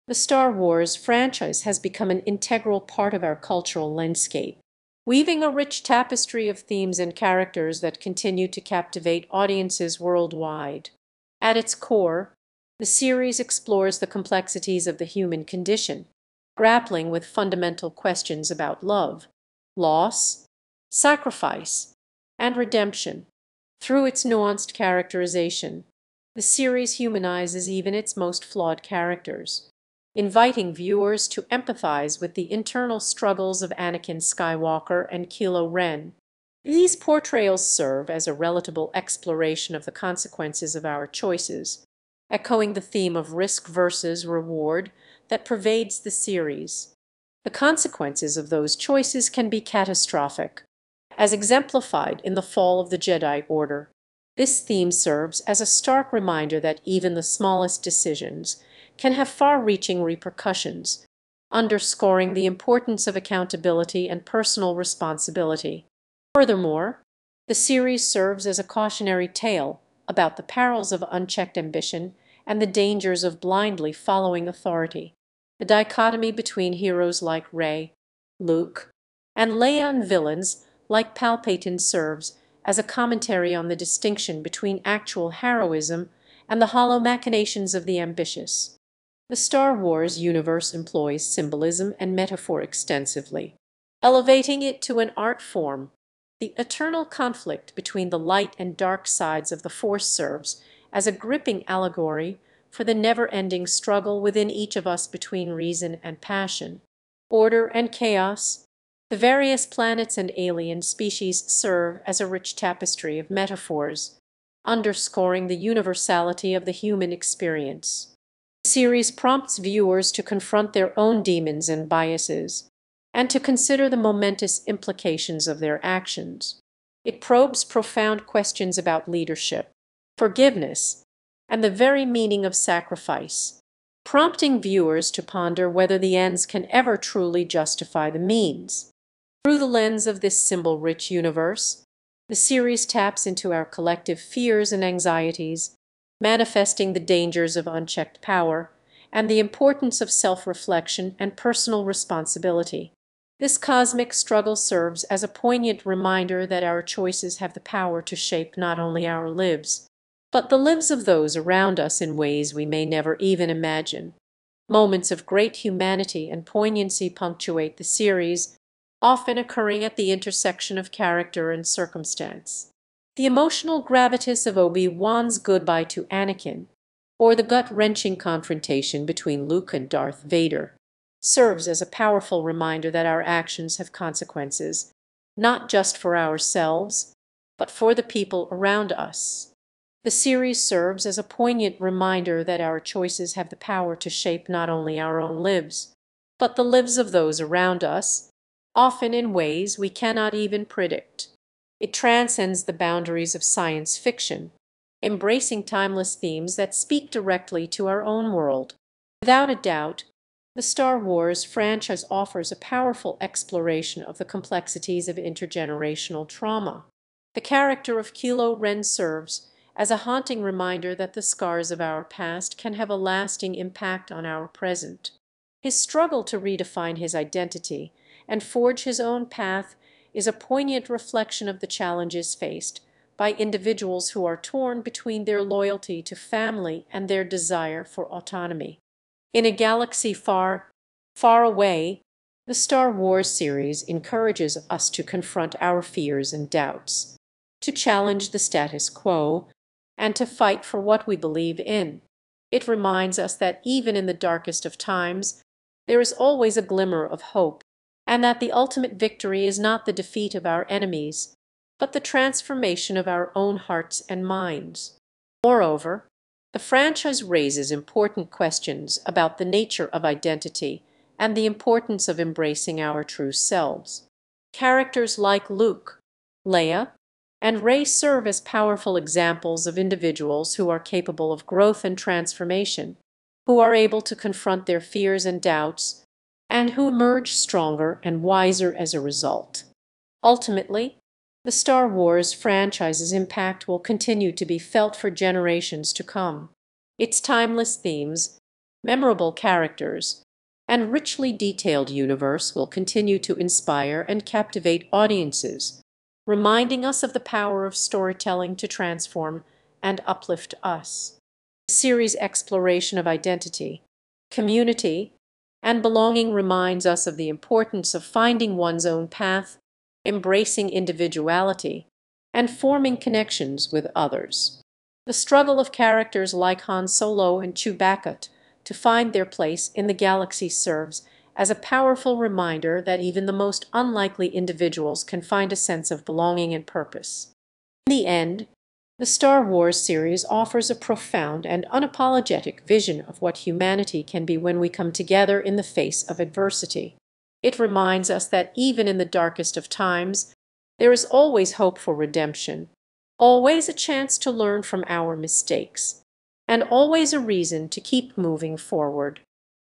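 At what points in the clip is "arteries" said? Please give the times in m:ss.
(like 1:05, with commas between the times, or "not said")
not said.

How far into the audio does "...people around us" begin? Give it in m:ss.
3:08.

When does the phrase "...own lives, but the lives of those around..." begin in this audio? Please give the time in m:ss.
3:15.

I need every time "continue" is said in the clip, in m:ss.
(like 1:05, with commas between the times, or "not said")
0:08, 4:53, 5:02.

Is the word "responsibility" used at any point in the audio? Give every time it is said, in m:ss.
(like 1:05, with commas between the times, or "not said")
1:04, 2:31.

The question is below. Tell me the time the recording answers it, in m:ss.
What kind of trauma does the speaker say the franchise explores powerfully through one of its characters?
3:35.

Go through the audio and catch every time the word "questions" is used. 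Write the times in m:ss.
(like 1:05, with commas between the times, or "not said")
0:17, 2:08, 4:28.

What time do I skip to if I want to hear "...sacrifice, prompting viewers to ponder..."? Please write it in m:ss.
2:12.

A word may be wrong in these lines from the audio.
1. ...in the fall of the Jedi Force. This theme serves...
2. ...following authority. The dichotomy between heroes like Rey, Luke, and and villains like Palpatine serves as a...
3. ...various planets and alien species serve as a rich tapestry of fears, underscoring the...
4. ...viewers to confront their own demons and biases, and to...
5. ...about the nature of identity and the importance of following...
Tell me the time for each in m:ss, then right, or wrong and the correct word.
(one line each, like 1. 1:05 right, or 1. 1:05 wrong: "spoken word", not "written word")
1. 0:52 wrong: "Order", not "Force"
2. 1:13 right
3. 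1:49 wrong: "metaphors", not "fears"
4. 1:59 right
5. 4:29 wrong: "embracing", not "following".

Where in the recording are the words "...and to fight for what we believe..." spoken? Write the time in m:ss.
4:09.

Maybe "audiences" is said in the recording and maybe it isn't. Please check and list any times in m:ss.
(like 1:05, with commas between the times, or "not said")
0:09, 5:04.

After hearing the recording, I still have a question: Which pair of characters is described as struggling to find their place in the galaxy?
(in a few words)
Han Solo and Chewbacca.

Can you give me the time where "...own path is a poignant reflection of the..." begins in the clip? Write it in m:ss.
3:48.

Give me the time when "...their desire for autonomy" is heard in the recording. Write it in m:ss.
3:57.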